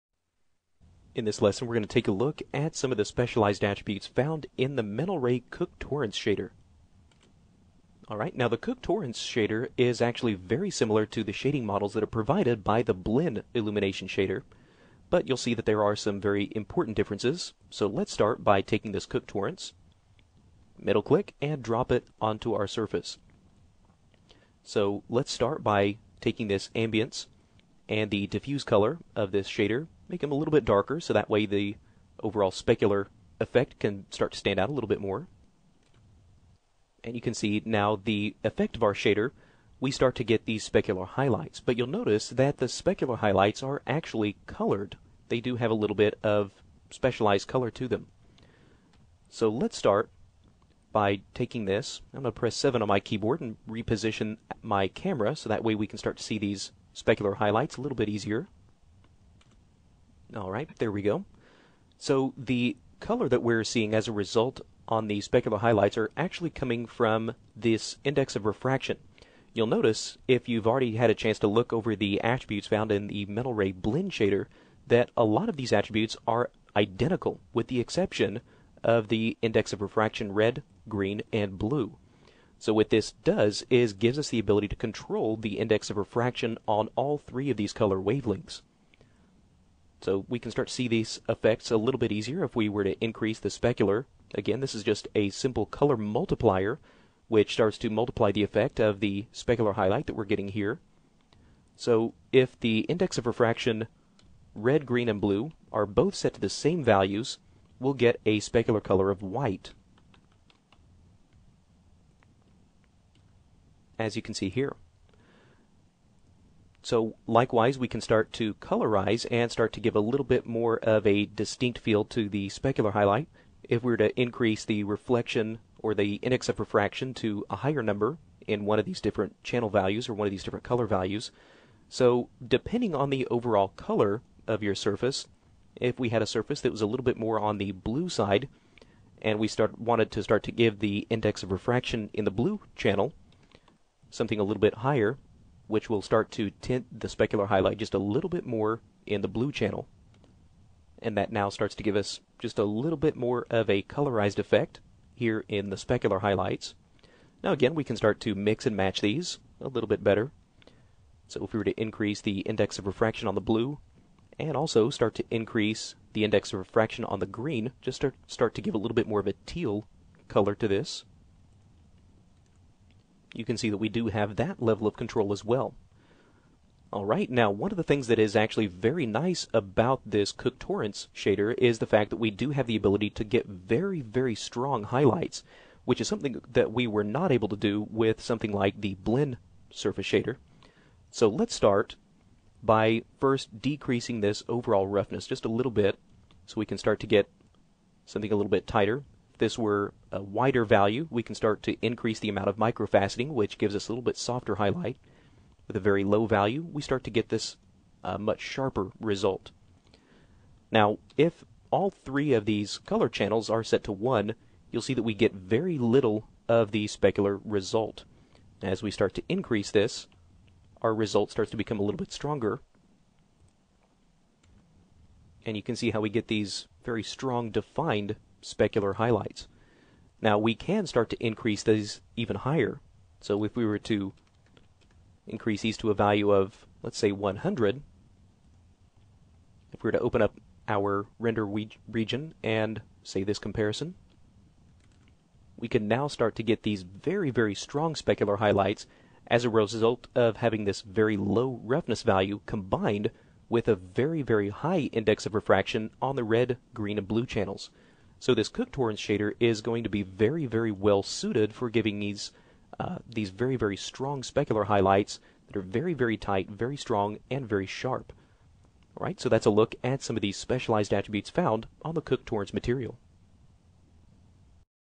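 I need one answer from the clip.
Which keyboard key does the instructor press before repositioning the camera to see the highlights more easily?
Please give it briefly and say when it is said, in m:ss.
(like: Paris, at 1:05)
7, at 0:52.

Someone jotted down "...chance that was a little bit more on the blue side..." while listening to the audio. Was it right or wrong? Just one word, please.
wrong.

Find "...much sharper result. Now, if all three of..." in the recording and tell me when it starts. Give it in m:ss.
3:28.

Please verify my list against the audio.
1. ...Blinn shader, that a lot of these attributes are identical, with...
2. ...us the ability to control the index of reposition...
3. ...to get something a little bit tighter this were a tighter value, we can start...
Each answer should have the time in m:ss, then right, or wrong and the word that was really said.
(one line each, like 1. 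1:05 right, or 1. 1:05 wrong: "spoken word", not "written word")
1. 1:13 right
2. 1:24 wrong: "refraction", not "reposition"
3. 3:16 wrong: "wider", not "tighter".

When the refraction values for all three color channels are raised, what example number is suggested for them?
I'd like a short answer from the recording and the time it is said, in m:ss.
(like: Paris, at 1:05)
100, at 3:57.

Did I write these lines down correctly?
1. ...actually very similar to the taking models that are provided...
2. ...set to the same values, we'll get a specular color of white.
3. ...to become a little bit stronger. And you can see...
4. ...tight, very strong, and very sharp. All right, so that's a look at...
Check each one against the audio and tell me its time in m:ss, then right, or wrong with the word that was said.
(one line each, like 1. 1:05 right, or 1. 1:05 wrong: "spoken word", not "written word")
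1. 0:10 wrong: "shading", not "taking"
2. 1:46 right
3. 3:41 right
4. 4:26 right.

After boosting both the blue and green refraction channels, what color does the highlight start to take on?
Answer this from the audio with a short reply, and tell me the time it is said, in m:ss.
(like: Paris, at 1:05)
Teal, at 2:49.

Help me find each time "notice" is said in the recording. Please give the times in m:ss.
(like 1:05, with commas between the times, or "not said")
0:41, 1:09.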